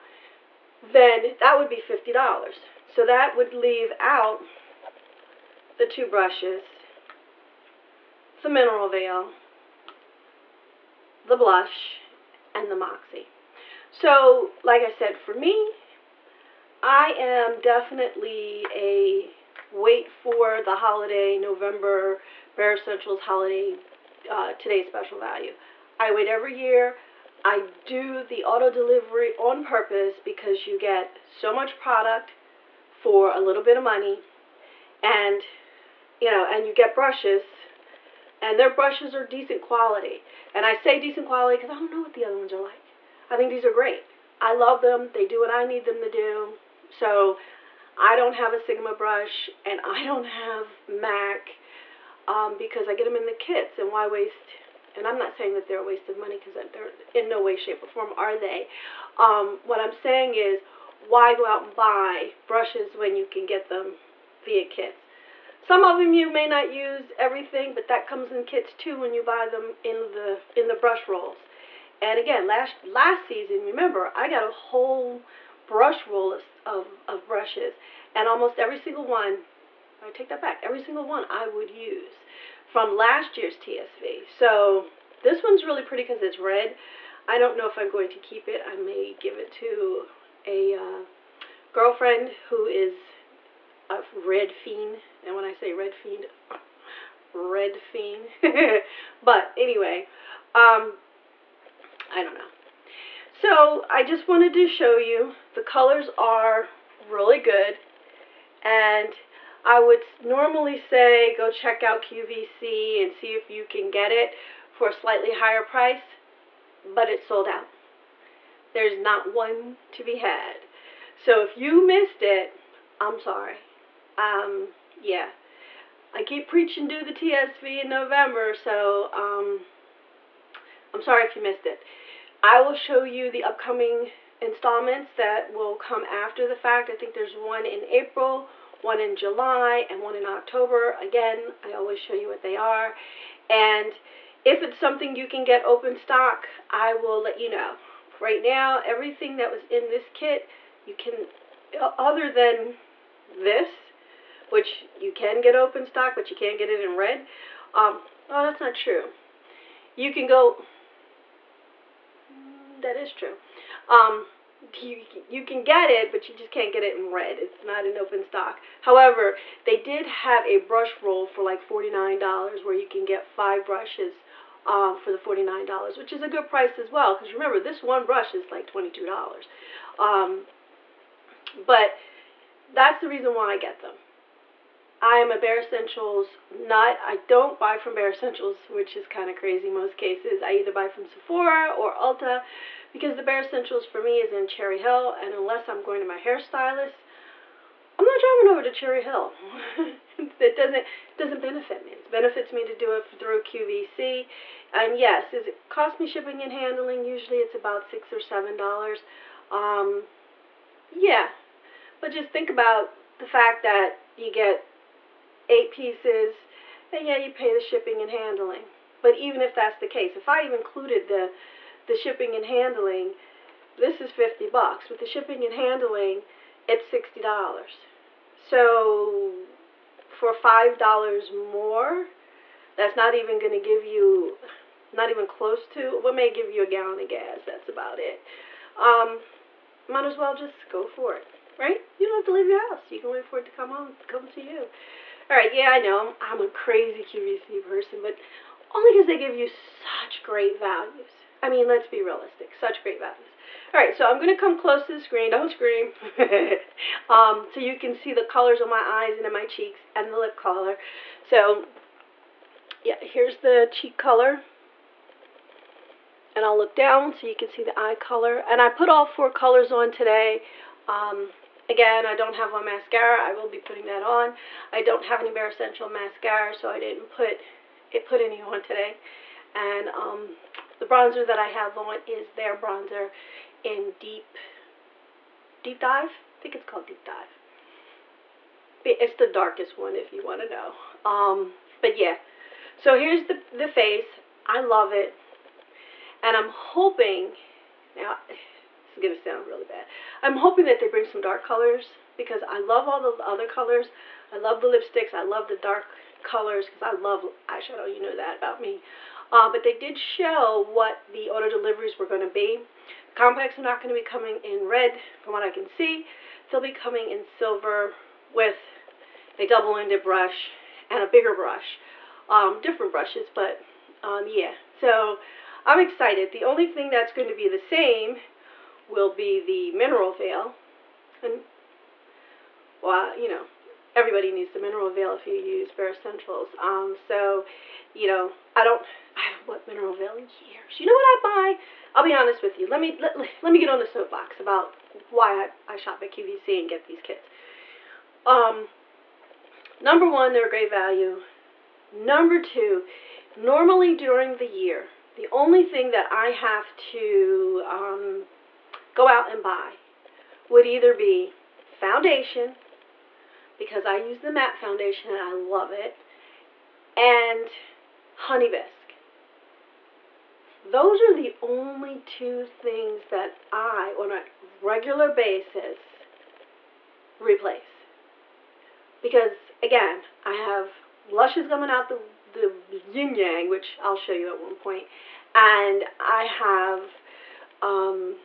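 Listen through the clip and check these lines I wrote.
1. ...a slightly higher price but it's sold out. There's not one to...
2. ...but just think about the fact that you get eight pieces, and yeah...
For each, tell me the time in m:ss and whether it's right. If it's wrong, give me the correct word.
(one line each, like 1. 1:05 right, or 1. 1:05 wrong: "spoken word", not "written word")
1. 1:54 right
2. 3:31 right.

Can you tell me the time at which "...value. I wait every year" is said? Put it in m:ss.
0:25.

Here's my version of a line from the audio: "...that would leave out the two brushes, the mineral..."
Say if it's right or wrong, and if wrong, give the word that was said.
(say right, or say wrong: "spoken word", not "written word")
right.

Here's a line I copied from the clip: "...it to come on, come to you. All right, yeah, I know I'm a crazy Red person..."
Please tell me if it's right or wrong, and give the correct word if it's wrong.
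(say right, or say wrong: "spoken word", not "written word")
wrong: "QVC", not "Red".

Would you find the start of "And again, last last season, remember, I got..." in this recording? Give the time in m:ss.
1:11.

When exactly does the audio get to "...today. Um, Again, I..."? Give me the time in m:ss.
4:29.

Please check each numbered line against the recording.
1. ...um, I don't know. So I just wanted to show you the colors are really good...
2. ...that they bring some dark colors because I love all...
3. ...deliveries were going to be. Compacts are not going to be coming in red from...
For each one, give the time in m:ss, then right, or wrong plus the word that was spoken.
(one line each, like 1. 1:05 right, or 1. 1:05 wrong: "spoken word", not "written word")
1. 1:40 right
2. 5:00 right
3. 5:11 right.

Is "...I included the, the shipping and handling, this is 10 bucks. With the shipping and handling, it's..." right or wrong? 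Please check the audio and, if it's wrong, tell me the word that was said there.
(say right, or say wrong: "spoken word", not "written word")
wrong: "50", not "10".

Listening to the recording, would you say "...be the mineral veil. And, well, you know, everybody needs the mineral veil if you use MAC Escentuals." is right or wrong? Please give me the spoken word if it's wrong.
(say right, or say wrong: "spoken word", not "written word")
wrong: "Bare", not "MAC".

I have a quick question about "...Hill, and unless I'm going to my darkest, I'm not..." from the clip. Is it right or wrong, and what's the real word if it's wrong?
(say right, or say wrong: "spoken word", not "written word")
wrong: "hairstylist", not "darkest".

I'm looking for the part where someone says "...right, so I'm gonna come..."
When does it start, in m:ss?
4:13.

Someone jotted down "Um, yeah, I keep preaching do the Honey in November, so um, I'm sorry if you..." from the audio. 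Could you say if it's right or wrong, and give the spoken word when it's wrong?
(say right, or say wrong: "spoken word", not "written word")
wrong: "TSV", not "Honey".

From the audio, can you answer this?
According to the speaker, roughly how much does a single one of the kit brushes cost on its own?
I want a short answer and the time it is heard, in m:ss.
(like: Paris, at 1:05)
$22, at 2:58.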